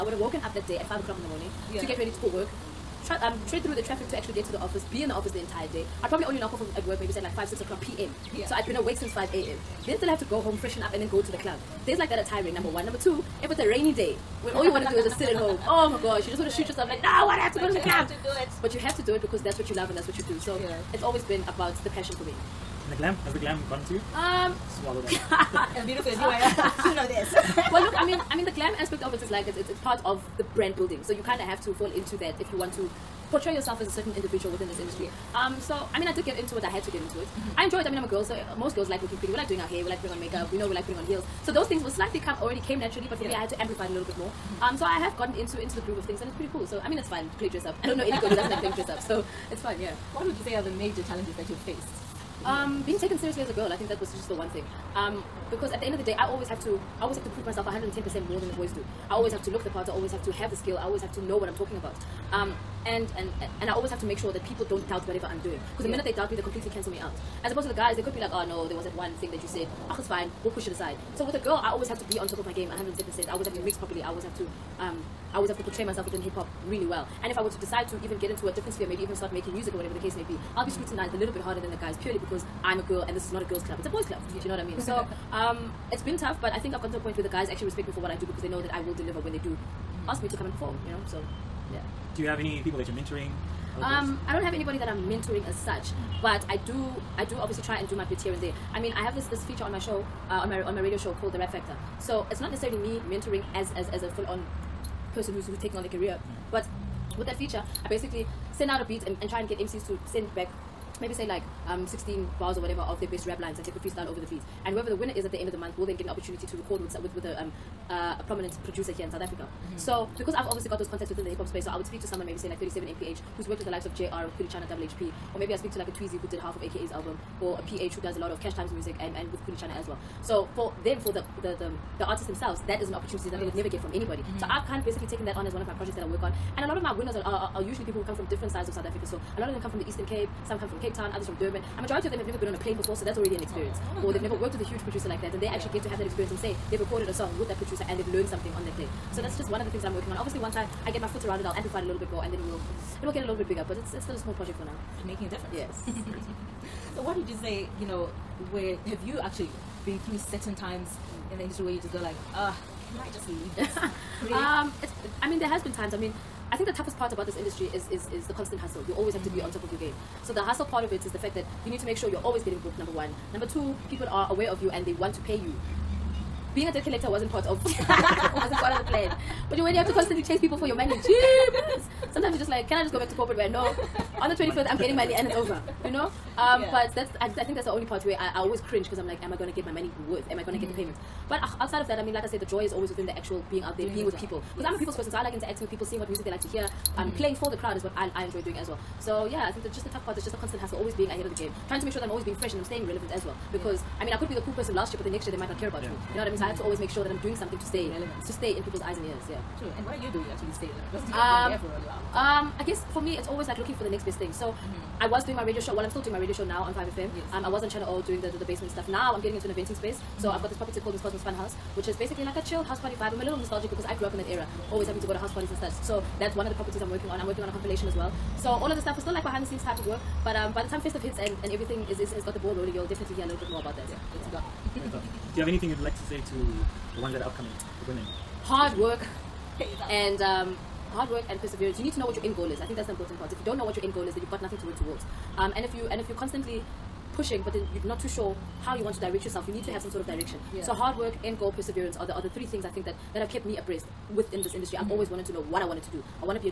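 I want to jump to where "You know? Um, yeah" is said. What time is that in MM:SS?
03:05.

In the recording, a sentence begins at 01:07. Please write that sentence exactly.
As opposed to the guys, they could be like, oh no, there was that one thing that you said.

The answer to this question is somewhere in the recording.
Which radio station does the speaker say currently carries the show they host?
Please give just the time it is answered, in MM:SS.
03:36.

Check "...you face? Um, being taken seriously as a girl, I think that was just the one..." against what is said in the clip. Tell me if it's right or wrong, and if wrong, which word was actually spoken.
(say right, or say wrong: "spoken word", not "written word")
right.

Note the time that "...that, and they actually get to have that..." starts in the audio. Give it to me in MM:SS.
02:25.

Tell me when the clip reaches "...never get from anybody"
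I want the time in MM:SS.
02:13.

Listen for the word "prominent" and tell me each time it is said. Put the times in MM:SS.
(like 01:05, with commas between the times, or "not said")
01:58.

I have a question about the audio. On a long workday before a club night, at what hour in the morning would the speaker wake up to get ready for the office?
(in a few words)
5 o'clock.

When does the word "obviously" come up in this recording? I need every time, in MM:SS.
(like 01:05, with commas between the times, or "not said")
01:37, 02:00, 02:30.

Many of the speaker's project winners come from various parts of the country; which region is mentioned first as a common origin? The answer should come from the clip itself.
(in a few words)
Eastern Cape.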